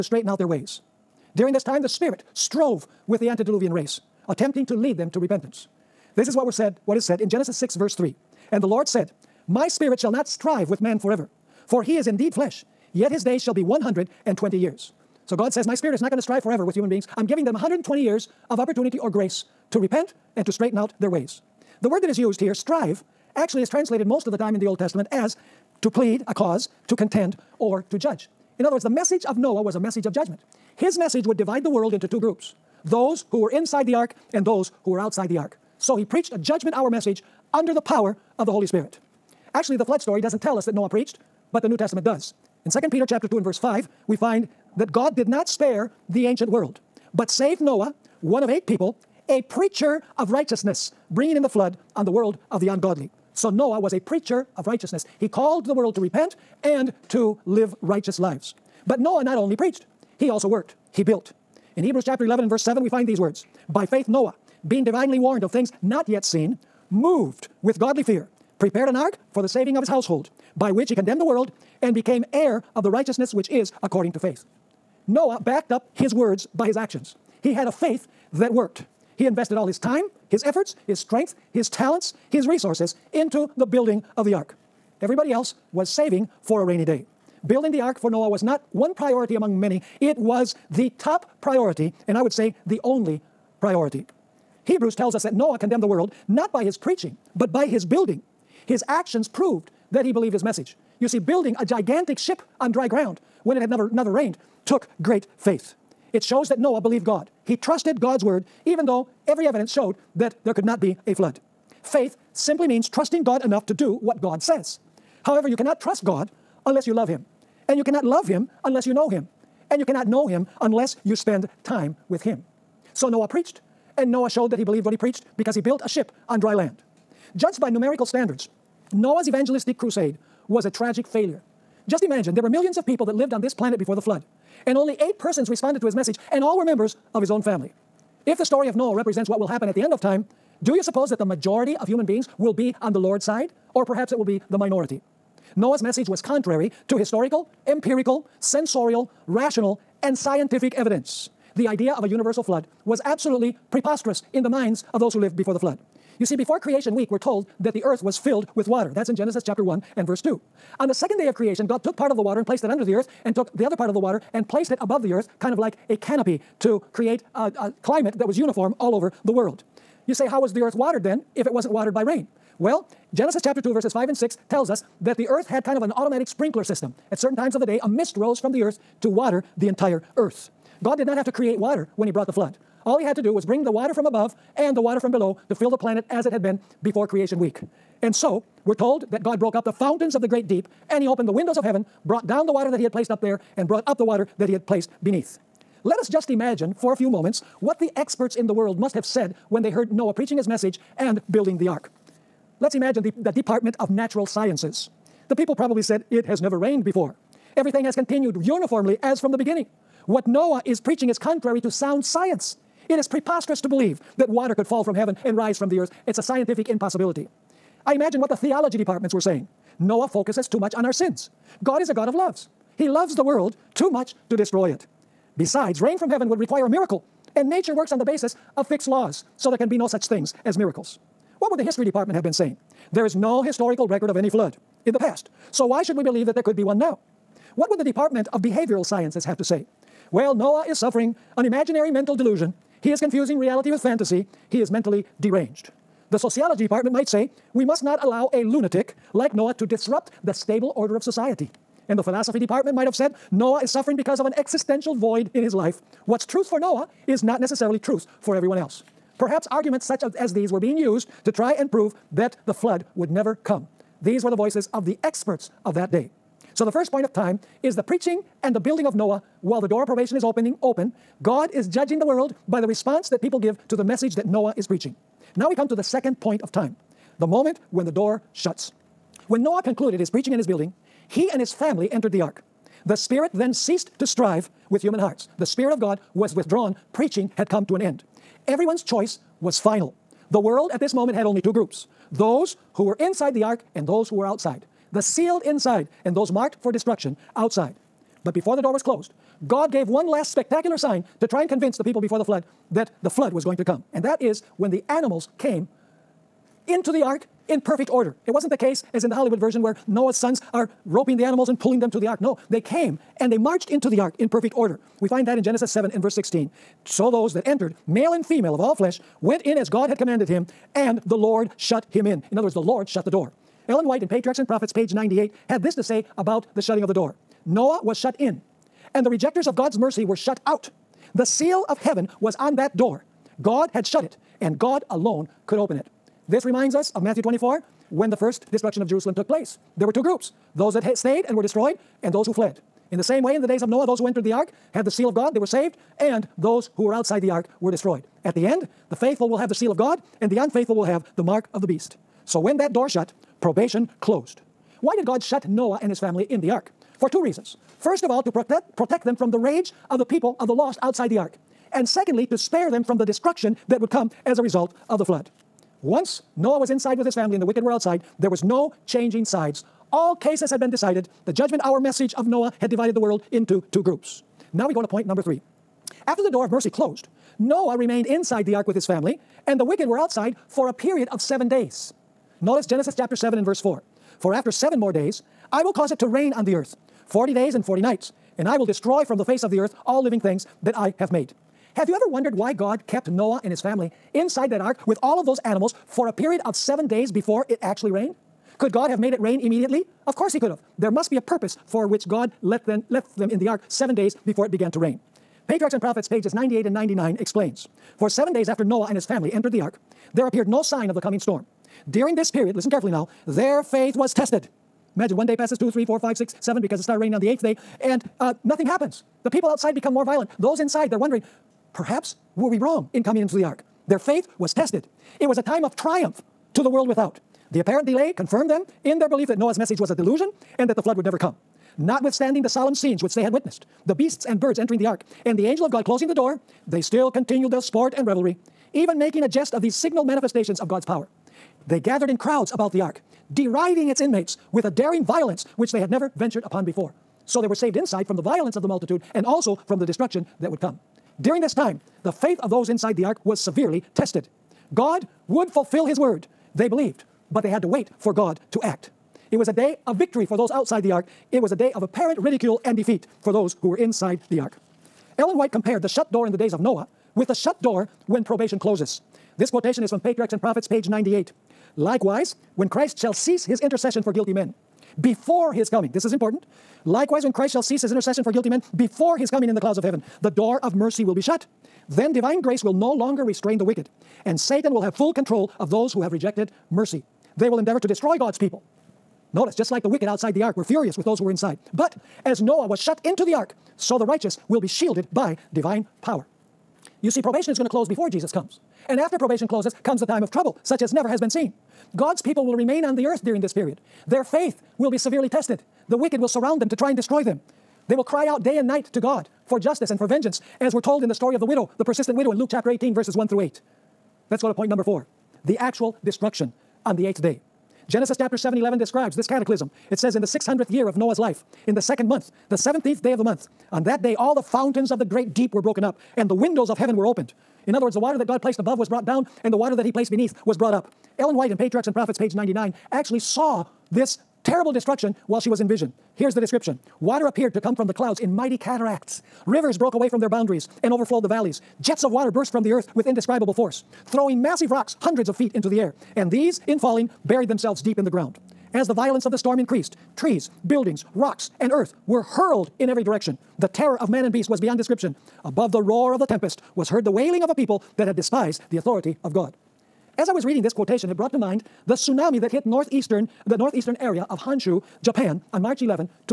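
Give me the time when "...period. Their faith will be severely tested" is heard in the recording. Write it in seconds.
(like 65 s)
503 s.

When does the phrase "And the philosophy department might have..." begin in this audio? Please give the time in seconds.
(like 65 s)
251 s.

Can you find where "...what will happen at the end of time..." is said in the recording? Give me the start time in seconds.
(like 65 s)
139 s.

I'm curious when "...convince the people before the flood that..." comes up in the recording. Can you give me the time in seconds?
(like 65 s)
301 s.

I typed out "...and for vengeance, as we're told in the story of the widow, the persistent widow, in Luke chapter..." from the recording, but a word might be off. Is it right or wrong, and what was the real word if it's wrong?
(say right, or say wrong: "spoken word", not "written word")
right.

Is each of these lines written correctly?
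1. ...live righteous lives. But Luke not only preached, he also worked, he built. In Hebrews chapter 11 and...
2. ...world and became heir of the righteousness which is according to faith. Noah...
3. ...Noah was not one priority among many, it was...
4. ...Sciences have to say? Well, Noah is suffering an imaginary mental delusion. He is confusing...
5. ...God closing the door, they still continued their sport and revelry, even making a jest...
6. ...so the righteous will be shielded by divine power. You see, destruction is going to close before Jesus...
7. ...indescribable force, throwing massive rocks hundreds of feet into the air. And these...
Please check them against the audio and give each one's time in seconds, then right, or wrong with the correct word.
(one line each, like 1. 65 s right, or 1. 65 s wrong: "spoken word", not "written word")
1. 57 s wrong: "Noah", not "Luke"
2. 71 s right
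3. 88 s right
4. 238 s right
5. 435 s right
6. 493 s wrong: "probation", not "destruction"
7. 543 s right.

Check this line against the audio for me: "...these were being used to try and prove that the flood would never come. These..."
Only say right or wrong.
right.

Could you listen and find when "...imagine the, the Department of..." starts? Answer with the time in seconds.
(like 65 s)
202 s.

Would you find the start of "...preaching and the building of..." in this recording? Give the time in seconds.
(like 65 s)
267 s.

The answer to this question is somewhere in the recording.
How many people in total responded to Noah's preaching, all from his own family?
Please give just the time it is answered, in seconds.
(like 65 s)
134 s.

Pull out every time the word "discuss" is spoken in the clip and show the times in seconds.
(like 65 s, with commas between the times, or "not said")
not said.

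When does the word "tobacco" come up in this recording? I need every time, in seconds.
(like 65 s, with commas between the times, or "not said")
not said.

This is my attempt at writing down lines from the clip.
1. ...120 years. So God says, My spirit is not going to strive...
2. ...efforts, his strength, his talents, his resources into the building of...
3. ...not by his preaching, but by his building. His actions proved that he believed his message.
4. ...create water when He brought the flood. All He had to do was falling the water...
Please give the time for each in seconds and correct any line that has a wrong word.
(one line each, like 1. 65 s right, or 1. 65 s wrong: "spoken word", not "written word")
1. 13 s right
2. 80 s right
3. 96 s right
4. 181 s wrong: "bring", not "falling".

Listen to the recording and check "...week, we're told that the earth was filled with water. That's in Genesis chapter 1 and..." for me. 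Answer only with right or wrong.
right.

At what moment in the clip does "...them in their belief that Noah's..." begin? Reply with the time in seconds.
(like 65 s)
428 s.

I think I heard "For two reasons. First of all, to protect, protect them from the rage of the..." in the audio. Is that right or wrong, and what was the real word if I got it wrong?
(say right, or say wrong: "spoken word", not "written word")
right.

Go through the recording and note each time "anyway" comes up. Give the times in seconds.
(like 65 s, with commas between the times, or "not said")
not said.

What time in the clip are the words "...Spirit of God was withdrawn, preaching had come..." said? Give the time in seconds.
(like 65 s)
285 s.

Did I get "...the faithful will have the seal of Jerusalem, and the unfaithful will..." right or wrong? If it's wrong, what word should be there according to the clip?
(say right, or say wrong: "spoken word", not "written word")
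wrong: "God", not "Jerusalem".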